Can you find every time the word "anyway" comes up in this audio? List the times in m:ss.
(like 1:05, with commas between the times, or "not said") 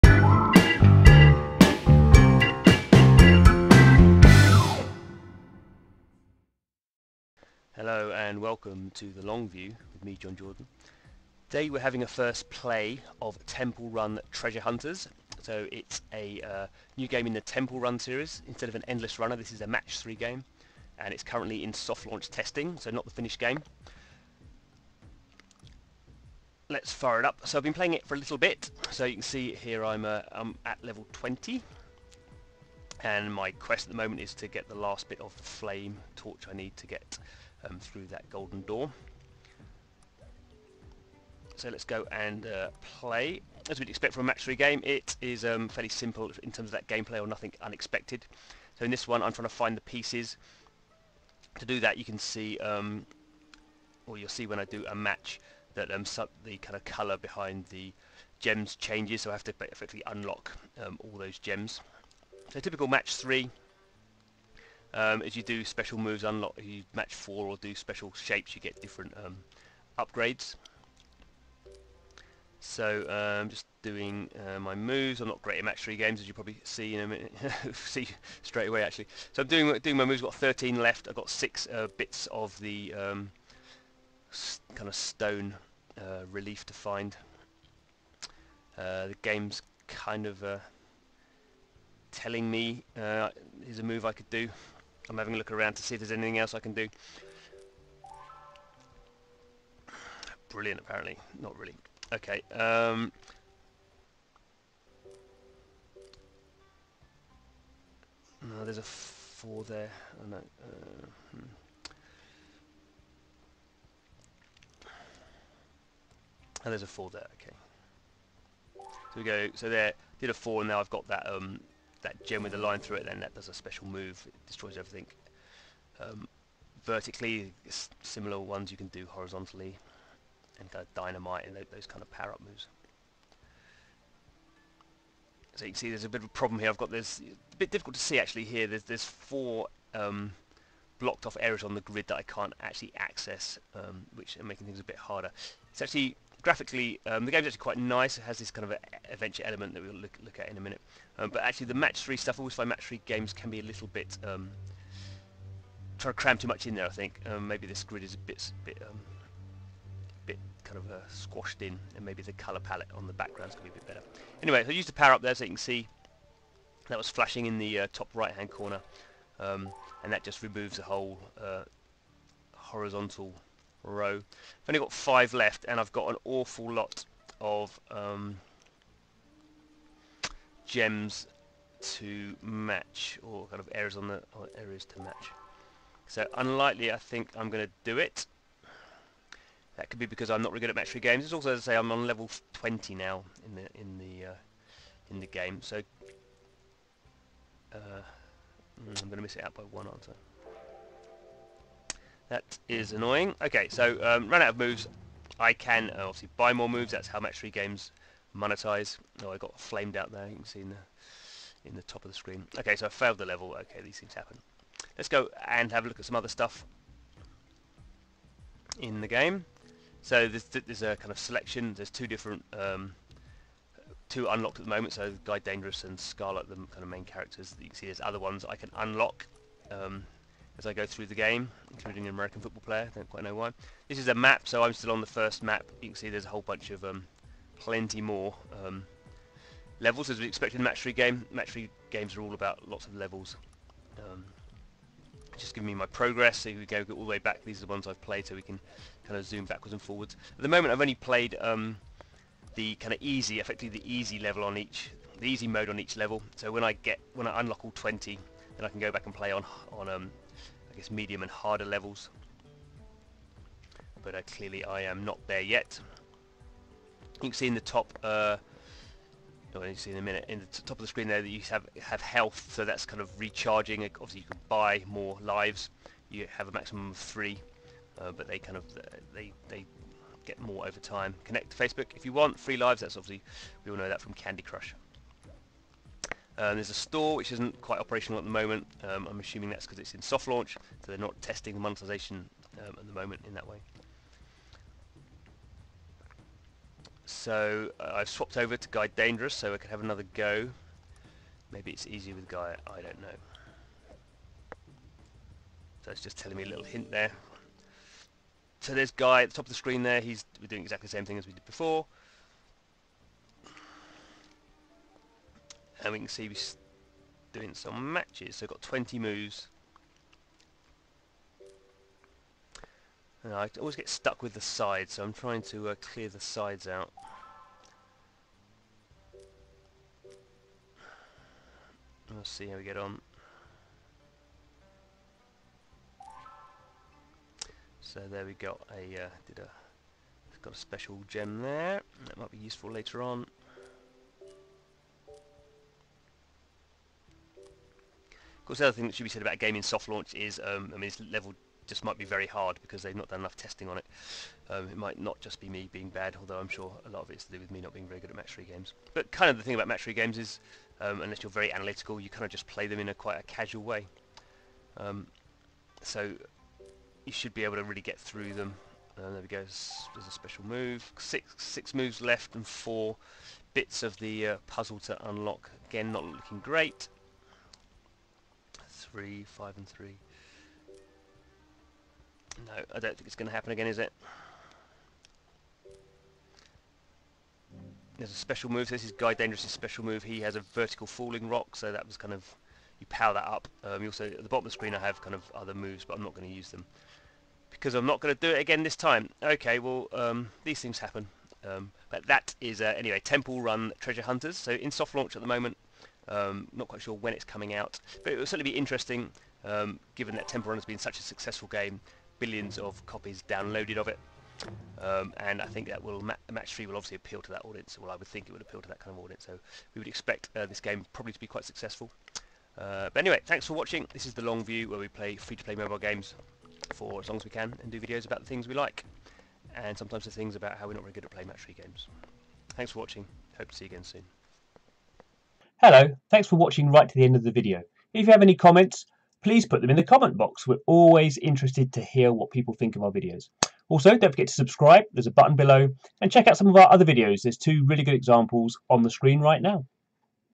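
2:44, 6:42, 7:02.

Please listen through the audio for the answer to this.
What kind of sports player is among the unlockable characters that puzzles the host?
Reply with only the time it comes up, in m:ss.
3:52.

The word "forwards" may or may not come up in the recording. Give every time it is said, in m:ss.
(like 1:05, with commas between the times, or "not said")
4:09.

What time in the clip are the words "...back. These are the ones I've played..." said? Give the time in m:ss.
4:07.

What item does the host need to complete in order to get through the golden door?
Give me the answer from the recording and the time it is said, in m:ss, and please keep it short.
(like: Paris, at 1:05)
flame torch, at 0:35.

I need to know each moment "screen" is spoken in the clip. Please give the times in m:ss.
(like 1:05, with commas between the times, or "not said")
3:32, 4:30, 5:09, 6:34, 7:28.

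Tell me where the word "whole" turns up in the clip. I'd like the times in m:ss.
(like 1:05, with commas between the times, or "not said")
2:50, 3:56.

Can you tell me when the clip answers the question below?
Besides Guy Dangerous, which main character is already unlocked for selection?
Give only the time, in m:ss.
3:45.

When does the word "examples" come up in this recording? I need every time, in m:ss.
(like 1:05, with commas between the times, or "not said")
7:27.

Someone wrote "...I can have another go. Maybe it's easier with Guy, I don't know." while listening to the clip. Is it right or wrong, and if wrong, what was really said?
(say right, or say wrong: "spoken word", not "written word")
right.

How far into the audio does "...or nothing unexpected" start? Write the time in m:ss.
0:47.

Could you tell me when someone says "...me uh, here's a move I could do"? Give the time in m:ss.
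1:32.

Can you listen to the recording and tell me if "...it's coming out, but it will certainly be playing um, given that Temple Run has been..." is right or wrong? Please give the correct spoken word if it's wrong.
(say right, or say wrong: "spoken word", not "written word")
wrong: "interesting", not "playing".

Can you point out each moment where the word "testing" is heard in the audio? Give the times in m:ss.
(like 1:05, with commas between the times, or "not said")
0:22, 4:51, 5:53.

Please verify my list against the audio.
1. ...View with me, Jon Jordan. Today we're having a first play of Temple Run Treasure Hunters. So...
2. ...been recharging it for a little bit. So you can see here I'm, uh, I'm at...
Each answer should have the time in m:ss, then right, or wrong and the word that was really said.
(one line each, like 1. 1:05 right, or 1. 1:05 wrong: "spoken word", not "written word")
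1. 0:09 right
2. 0:27 wrong: "playing", not "recharging".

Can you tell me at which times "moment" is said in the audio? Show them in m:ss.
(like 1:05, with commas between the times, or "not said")
0:33, 3:44, 4:10, 4:48, 4:52, 6:45.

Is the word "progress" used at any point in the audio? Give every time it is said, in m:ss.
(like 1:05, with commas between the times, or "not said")
4:05.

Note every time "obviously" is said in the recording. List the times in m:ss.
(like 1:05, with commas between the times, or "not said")
3:26, 4:33, 4:42, 6:56.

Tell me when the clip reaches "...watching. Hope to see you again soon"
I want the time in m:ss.
7:12.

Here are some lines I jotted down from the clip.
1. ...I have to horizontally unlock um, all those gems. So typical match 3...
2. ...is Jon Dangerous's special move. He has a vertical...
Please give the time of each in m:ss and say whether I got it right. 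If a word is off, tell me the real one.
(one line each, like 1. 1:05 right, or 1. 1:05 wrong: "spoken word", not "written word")
1. 0:59 wrong: "effectively", not "horizontally"
2. 6:28 wrong: "Guy", not "Jon".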